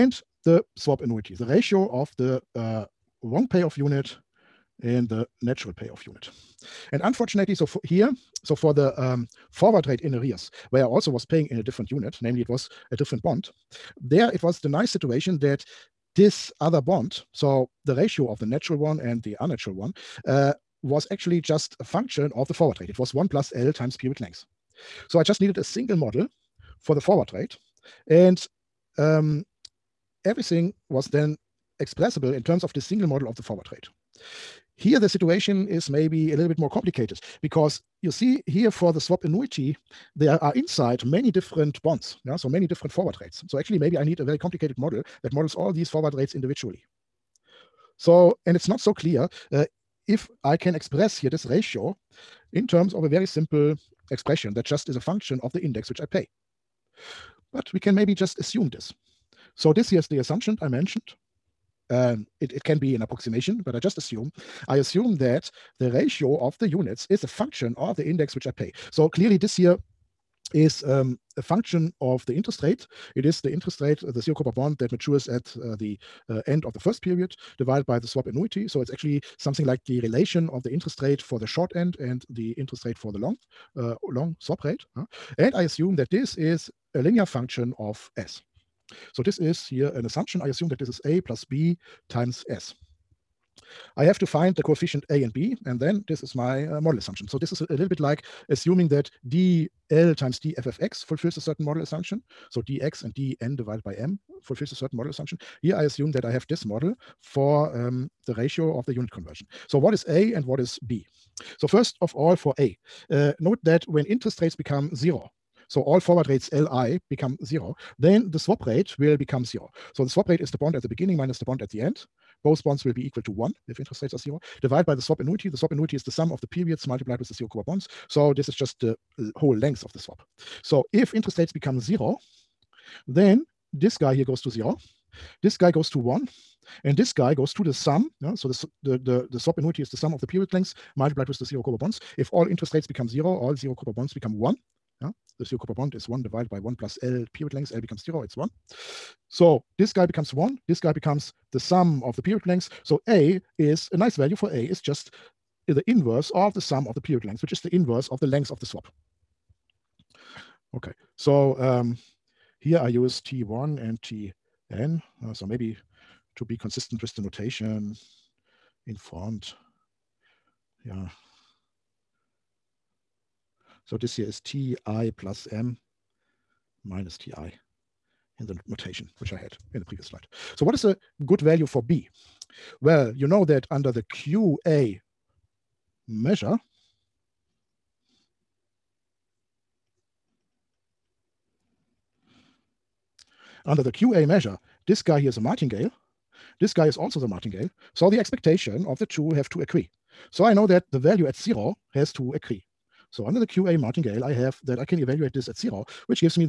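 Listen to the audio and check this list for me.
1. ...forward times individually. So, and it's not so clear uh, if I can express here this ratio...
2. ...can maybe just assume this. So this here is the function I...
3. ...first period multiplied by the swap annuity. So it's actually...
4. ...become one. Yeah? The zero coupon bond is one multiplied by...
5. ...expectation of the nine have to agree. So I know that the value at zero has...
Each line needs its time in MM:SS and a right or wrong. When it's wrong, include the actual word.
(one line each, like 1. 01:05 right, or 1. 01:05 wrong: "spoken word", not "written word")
1. 00:45 wrong: "rates", not "times"
2. 00:57 wrong: "assumption", not "function"
3. 01:16 wrong: "divided", not "multiplied"
4. 02:24 wrong: "divided", not "multiplied"
5. 03:18 wrong: "two", not "nine".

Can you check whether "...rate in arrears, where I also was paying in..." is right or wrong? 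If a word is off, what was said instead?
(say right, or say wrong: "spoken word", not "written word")
right.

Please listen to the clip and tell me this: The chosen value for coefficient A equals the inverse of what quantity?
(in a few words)
the length of the swap.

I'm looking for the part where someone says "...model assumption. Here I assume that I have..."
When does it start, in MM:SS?
01:44.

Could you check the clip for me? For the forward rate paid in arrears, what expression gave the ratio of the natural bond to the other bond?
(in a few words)
1 plus L times period length.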